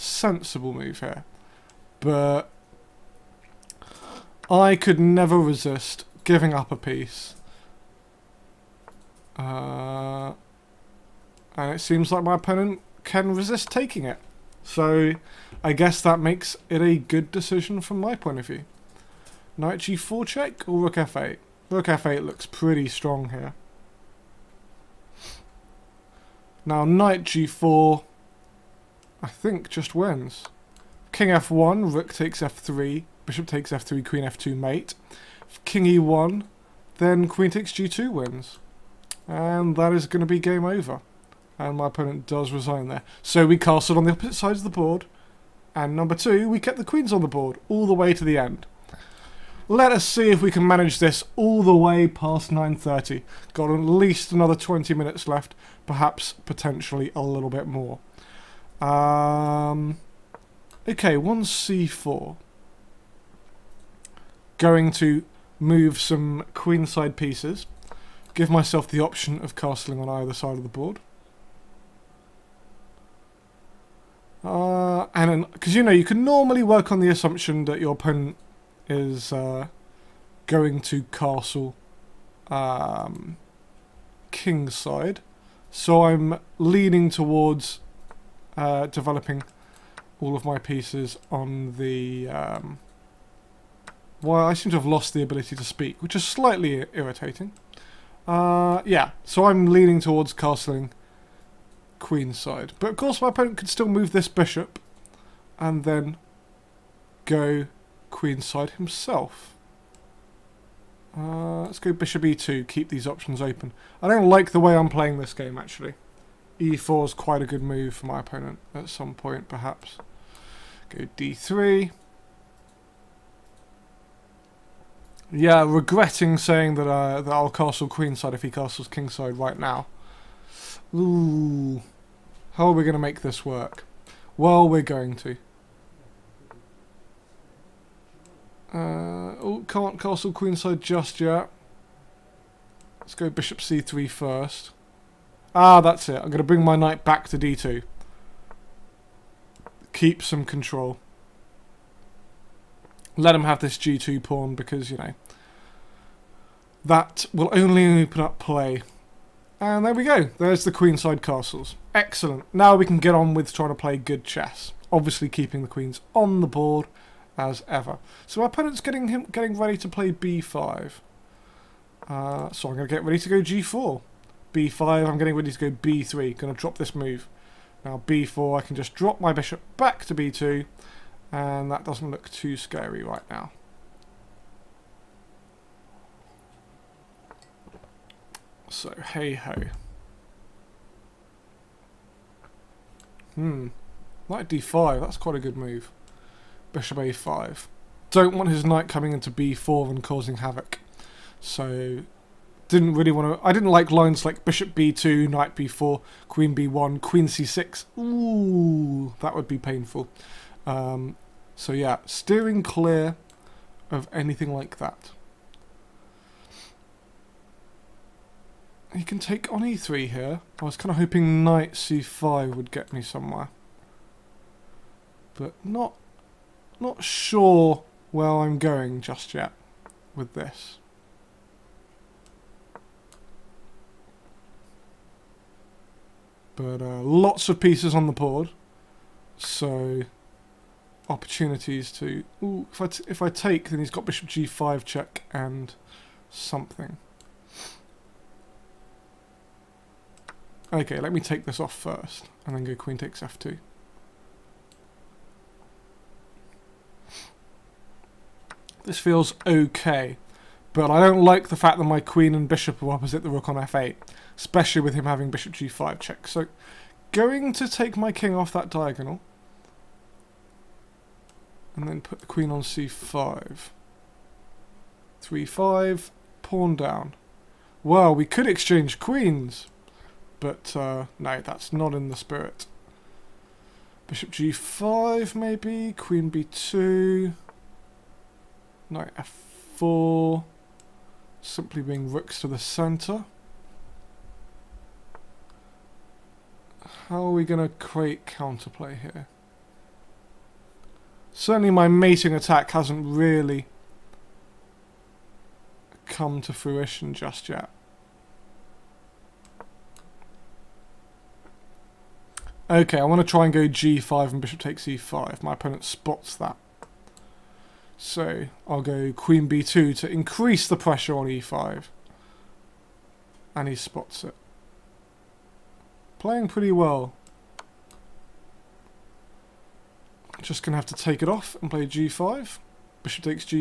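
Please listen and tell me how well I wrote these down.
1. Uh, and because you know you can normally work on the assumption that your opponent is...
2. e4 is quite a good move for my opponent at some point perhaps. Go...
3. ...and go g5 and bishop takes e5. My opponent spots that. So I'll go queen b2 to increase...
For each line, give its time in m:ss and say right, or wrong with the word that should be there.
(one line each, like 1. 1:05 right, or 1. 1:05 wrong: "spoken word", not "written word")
1. 1:14 right
2. 1:56 right
3. 5:13 right.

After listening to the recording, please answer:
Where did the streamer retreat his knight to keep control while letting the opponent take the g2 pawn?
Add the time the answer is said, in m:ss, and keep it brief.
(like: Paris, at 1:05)
d2, at 2:27.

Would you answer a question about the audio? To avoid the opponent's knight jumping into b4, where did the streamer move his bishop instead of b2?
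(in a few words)
a5.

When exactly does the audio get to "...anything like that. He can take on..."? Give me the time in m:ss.
3:34.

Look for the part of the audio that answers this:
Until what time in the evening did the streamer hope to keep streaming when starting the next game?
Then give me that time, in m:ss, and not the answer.
0:52.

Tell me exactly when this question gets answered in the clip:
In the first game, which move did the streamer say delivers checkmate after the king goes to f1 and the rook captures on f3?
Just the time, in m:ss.
0:34.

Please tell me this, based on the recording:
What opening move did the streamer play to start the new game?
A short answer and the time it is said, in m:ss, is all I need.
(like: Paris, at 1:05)
c4, at 1:01.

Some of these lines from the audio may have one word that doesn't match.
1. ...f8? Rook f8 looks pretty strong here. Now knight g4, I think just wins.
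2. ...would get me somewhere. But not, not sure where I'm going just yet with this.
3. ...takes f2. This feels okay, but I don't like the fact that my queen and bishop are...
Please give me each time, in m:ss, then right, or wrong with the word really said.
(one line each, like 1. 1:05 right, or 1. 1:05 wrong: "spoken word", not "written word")
1. 0:20 right
2. 3:42 right
3. 4:12 right.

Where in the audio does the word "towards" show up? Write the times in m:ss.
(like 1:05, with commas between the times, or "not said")
1:27, 1:39.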